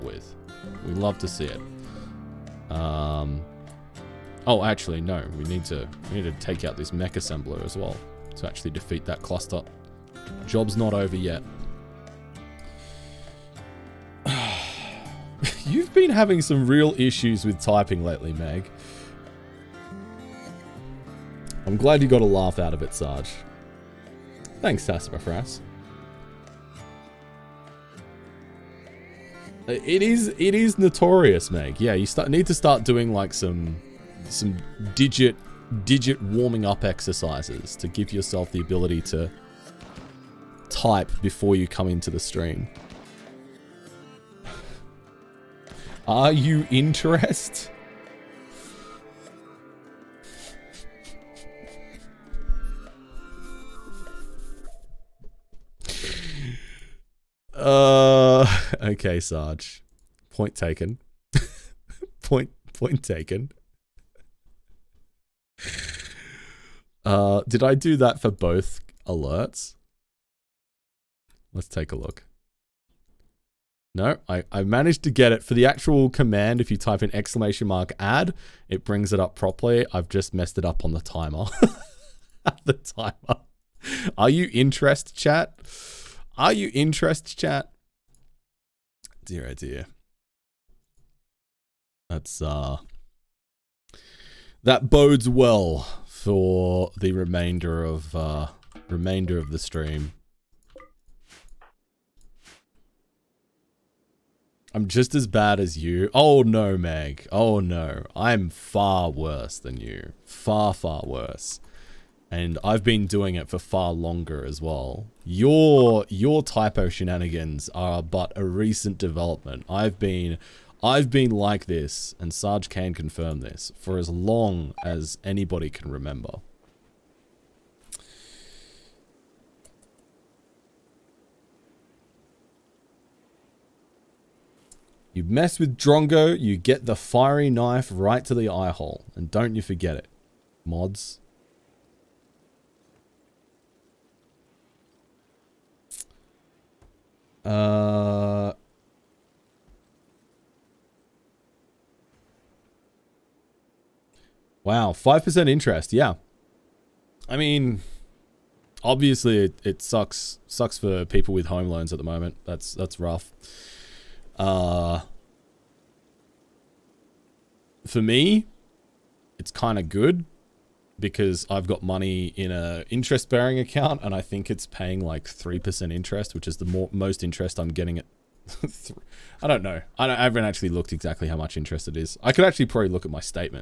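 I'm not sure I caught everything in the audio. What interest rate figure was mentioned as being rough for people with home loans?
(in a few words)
5%.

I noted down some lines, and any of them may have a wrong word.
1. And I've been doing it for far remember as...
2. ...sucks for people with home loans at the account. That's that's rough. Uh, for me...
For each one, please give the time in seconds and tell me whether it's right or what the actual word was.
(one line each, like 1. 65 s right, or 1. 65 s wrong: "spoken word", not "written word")
1. 112 s wrong: "longer", not "remember"
2. 160 s wrong: "moment", not "account".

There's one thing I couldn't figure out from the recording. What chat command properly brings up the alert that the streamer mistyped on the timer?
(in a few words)
!add.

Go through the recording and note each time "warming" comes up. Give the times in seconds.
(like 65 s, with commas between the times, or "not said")
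36 s.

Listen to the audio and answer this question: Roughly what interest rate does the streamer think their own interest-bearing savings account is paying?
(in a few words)
3%.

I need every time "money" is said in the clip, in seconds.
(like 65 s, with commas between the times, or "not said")
171 s.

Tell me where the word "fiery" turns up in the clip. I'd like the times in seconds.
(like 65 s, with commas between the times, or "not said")
136 s.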